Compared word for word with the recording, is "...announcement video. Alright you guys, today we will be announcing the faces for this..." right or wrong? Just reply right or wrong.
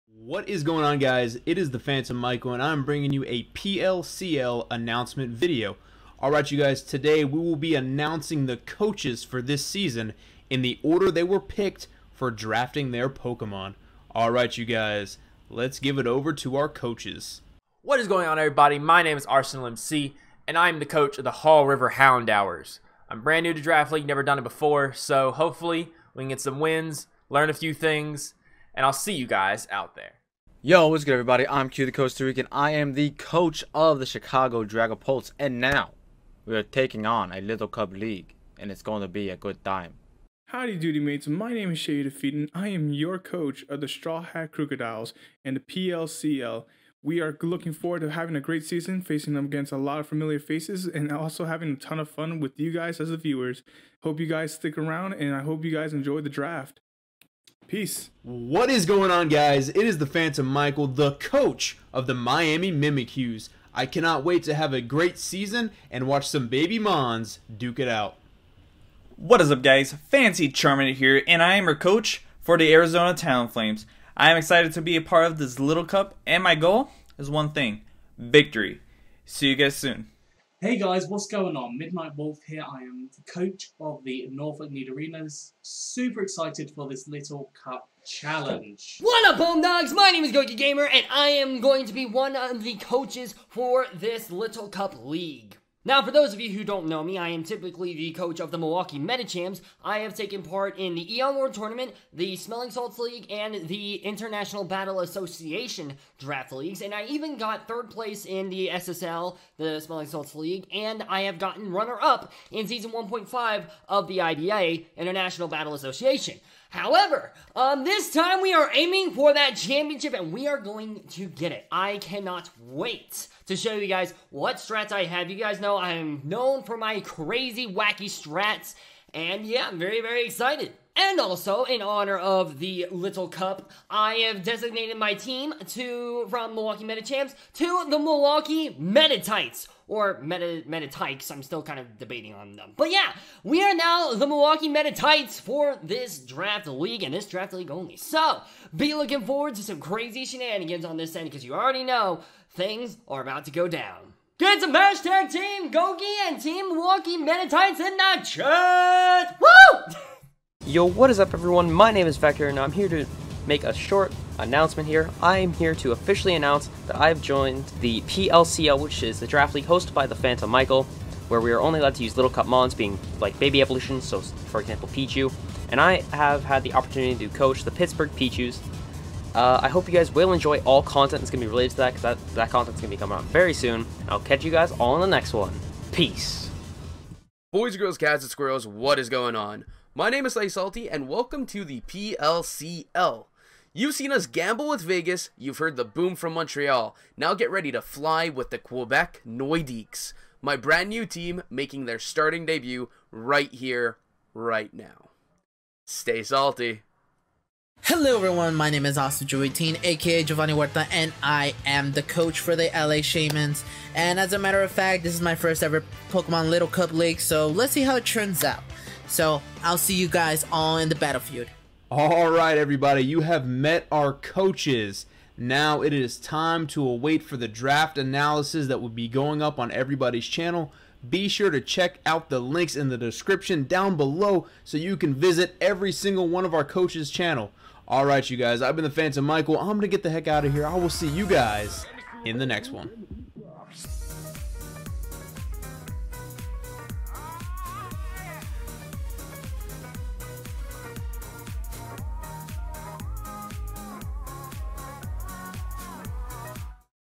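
wrong.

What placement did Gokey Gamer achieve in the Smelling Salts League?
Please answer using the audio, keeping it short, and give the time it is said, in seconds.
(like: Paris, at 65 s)
Third place, at 107 s.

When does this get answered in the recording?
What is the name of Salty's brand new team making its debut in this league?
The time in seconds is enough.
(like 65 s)
198 s.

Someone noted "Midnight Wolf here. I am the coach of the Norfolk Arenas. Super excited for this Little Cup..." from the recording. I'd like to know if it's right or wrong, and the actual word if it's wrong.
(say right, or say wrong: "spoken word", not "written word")
right.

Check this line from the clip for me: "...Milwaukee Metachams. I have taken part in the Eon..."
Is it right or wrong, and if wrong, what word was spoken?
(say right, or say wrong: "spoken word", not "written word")
right.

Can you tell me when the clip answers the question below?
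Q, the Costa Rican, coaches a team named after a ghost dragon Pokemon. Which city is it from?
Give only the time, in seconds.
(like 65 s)
34 s.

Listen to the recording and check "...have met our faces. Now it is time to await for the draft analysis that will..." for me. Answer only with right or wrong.
wrong.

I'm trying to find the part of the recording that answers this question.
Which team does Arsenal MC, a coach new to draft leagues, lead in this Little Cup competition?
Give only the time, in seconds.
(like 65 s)
21 s.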